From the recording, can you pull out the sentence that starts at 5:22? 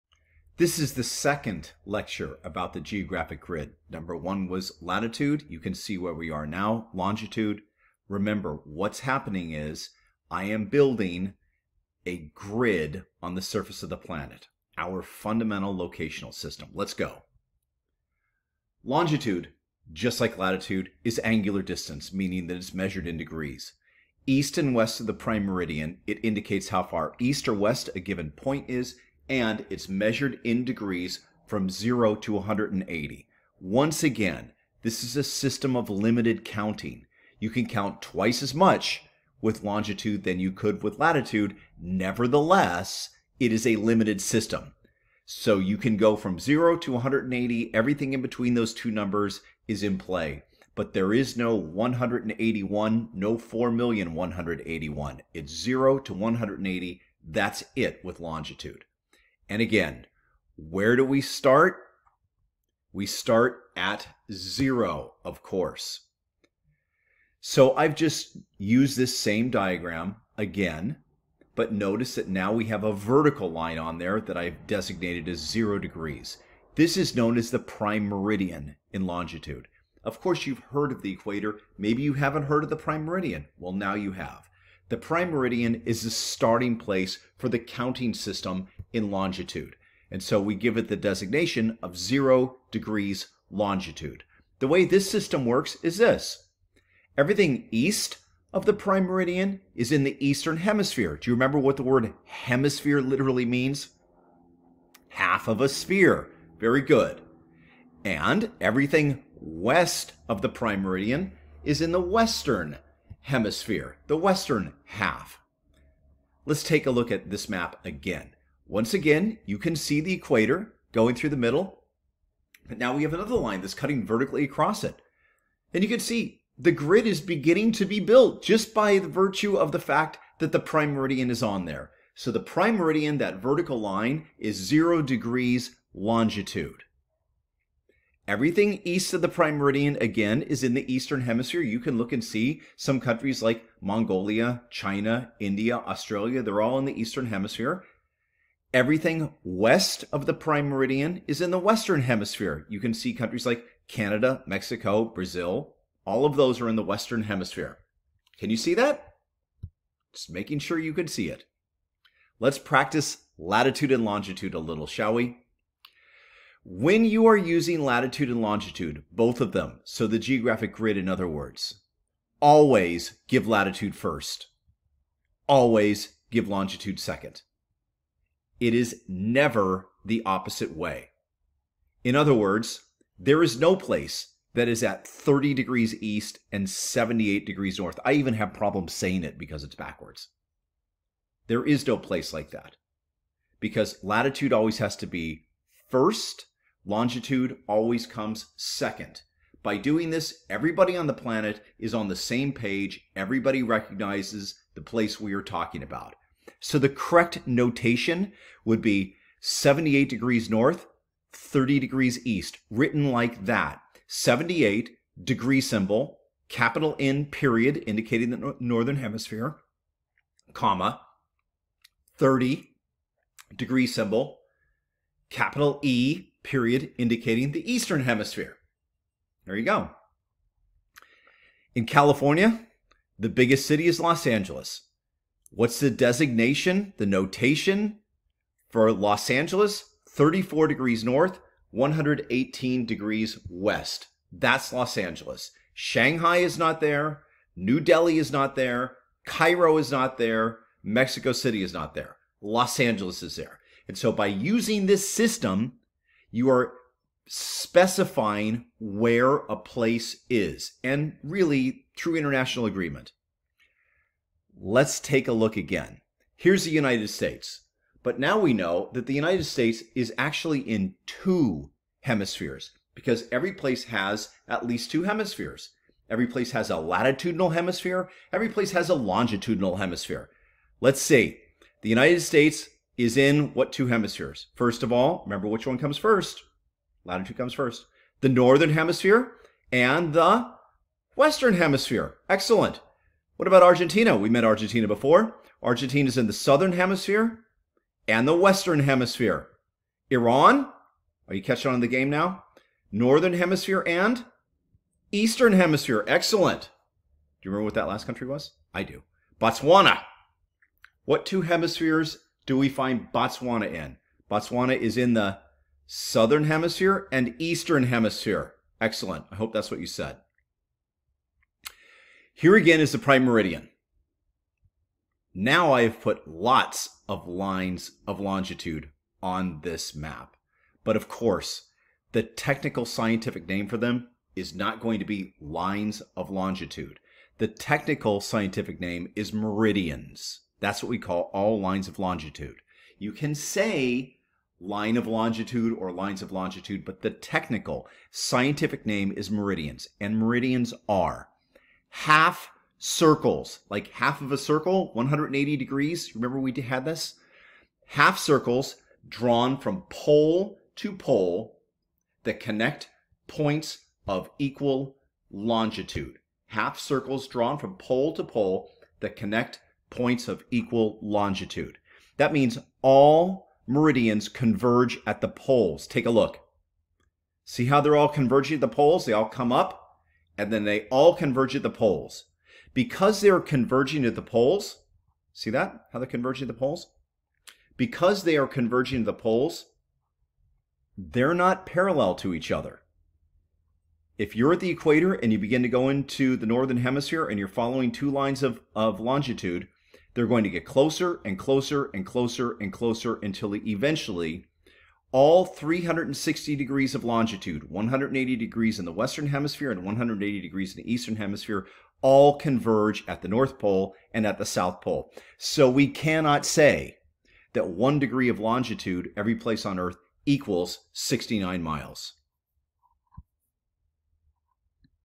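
Here again is the prime meridian.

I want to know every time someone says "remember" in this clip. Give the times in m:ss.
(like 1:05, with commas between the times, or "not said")
0:08, 1:41, 4:45, 5:07, 5:56.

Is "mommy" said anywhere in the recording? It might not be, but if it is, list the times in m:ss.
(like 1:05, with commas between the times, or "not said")
not said.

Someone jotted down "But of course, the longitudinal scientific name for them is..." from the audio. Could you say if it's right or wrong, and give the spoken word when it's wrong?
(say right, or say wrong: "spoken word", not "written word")
wrong: "technical", not "longitudinal".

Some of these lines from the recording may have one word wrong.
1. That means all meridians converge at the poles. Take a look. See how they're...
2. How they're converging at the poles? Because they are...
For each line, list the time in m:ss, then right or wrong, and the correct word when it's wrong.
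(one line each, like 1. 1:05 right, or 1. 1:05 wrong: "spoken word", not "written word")
1. 6:12 right
2. 6:25 right.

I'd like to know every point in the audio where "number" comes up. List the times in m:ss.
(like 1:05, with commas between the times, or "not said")
0:03, 0:48.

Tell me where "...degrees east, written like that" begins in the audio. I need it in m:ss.
3:31.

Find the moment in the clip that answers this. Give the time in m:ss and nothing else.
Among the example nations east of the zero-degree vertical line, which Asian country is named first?
2:23.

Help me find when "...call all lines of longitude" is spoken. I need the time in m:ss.
5:40.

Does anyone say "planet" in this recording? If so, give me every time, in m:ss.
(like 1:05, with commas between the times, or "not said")
0:13, 3:21.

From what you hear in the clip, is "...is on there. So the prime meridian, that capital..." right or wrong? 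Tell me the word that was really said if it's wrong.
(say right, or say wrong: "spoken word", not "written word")
wrong: "vertical", not "capital".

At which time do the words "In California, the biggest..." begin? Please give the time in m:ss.
3:51.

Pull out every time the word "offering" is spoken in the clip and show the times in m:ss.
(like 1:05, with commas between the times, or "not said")
not said.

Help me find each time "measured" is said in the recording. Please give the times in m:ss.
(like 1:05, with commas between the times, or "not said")
0:22, 0:29.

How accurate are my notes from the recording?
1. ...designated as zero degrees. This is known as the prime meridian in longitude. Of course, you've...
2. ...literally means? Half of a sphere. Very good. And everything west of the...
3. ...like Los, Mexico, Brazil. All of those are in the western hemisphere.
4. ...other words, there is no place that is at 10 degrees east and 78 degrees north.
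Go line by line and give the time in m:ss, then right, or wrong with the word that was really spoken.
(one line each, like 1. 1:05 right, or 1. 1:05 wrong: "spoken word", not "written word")
1. 1:14 right
2. 1:43 right
3. 2:33 wrong: "Canada", not "Los"
4. 3:02 wrong: "30", not "10".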